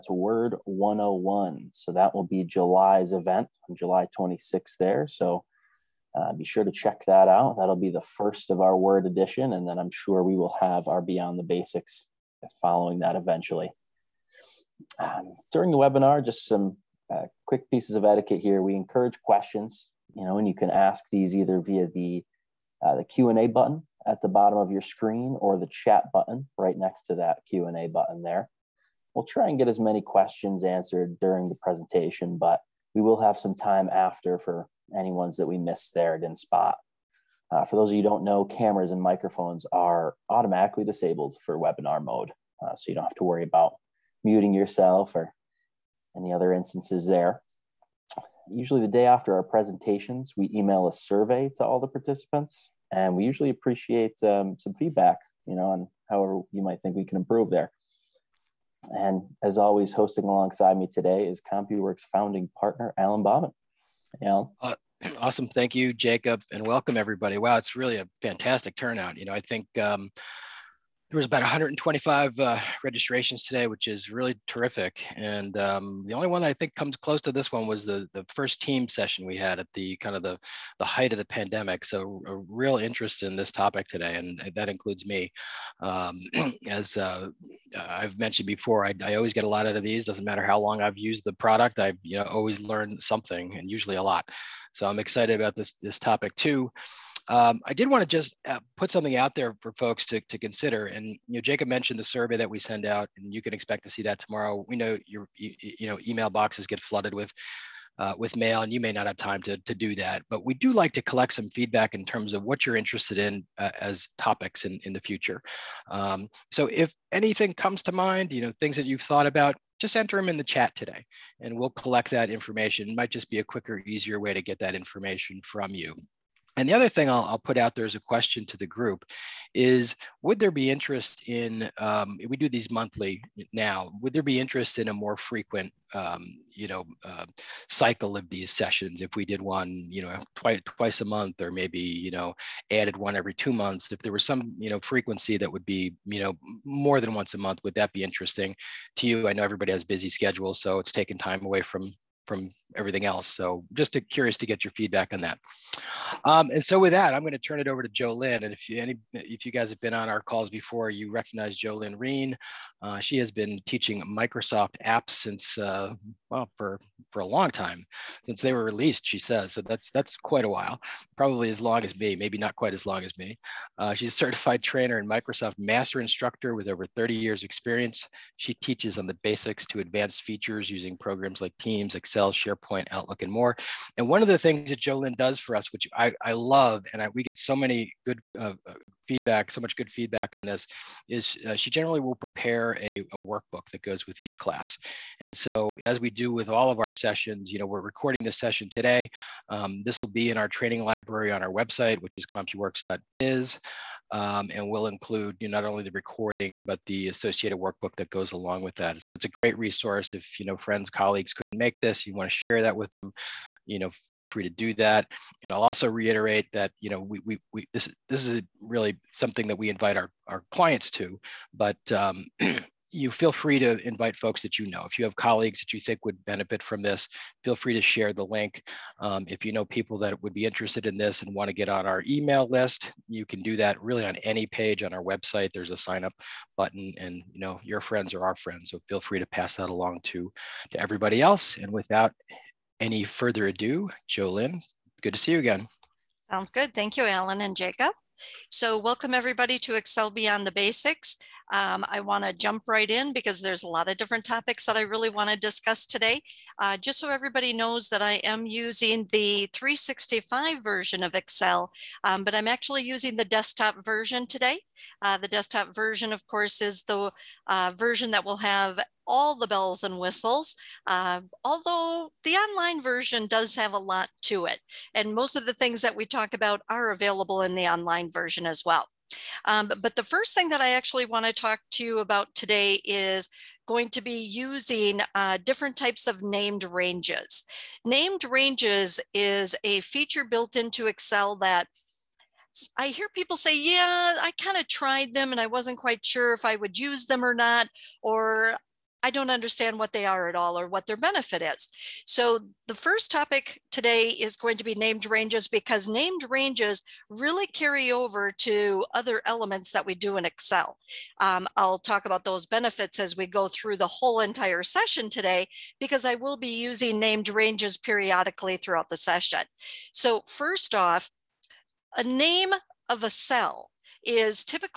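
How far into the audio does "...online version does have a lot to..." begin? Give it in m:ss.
4:32.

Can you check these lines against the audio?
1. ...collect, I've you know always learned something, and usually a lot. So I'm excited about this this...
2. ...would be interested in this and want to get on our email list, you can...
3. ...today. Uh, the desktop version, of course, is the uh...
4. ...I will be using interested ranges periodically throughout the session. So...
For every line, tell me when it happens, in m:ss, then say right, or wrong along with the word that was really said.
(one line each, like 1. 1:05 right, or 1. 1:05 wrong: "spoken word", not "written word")
1. 1:31 wrong: "product", not "collect"
2. 3:50 right
3. 4:24 right
4. 5:16 wrong: "named", not "interested".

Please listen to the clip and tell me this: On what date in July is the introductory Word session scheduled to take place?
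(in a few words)
July 26th.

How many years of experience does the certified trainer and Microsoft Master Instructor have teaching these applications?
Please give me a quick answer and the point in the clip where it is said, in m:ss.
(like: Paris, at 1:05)
over 30, at 2:56.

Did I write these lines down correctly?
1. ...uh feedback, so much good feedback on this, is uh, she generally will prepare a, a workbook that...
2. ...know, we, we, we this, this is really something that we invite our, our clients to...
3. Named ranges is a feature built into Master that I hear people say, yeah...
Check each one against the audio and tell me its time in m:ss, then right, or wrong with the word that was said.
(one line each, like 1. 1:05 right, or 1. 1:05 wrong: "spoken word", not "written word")
1. 3:08 right
2. 3:36 right
3. 4:47 wrong: "Excel", not "Master".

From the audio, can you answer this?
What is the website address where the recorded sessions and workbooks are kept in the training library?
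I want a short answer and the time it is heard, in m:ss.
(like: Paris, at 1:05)
CompuWorks.biz, at 3:22.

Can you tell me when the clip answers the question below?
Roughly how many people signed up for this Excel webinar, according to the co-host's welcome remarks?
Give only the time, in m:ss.
1:11.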